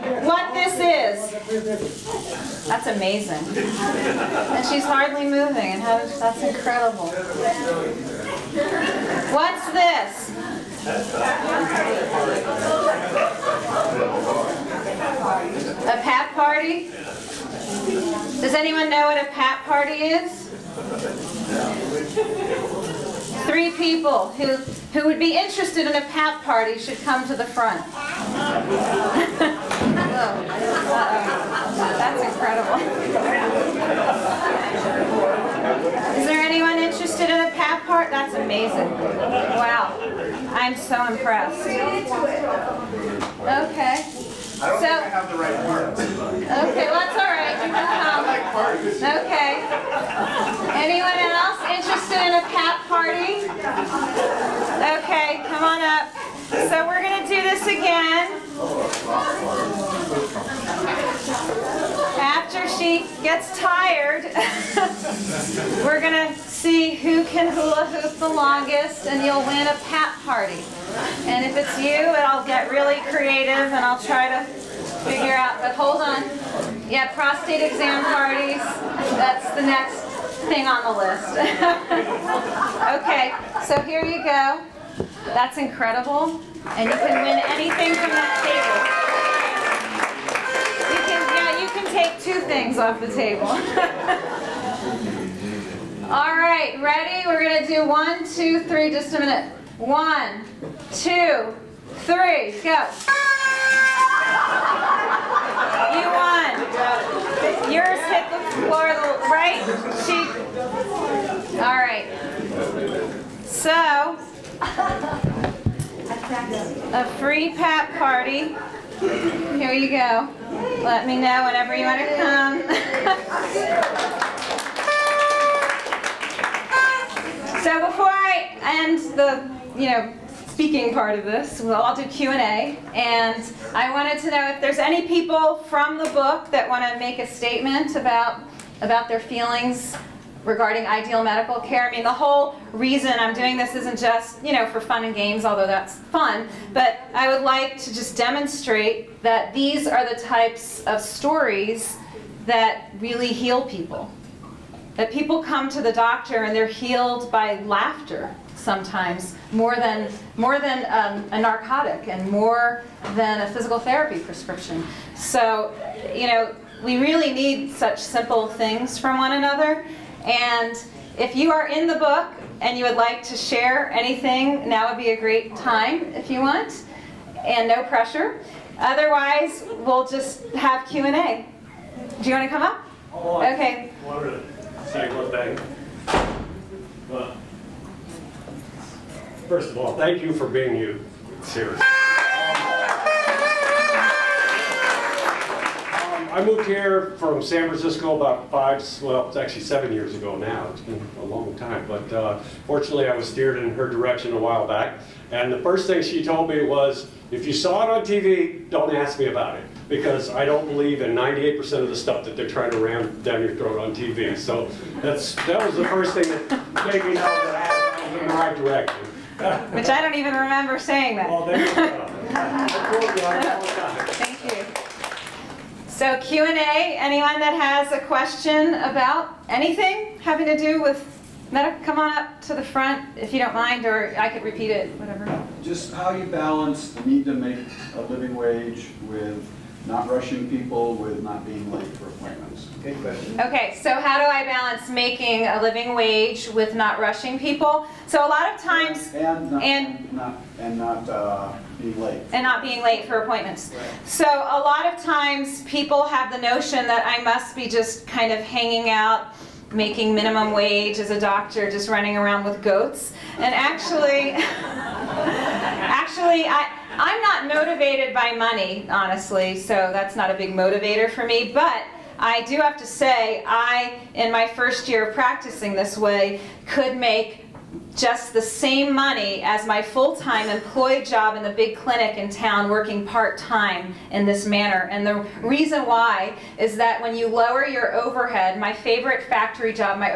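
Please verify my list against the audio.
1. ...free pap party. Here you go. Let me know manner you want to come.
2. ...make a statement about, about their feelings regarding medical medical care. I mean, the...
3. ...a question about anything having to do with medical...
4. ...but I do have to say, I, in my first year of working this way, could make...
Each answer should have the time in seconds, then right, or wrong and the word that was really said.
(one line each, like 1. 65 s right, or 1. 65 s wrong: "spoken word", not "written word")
1. 117 s wrong: "whenever", not "manner"
2. 136 s wrong: "ideal", not "medical"
3. 227 s right
4. 271 s wrong: "practicing", not "working".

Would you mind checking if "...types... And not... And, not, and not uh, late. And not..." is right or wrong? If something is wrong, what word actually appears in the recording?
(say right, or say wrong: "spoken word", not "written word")
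wrong: "times", not "types".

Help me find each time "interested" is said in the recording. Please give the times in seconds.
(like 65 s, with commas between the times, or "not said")
25 s, 36 s, 51 s.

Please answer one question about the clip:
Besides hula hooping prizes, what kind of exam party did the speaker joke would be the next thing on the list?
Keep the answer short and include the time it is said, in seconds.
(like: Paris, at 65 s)
prostate exam parties, at 77 s.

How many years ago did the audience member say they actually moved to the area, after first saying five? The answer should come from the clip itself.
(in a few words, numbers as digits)
7.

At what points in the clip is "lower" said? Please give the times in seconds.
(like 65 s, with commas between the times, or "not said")
287 s.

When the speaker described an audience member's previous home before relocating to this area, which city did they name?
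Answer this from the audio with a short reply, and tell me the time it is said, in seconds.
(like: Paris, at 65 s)
San Francisco, at 197 s.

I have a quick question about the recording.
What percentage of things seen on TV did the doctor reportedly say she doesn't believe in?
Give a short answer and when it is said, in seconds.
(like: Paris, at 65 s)
98%, at 211 s.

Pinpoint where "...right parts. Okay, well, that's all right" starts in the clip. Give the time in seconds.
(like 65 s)
45 s.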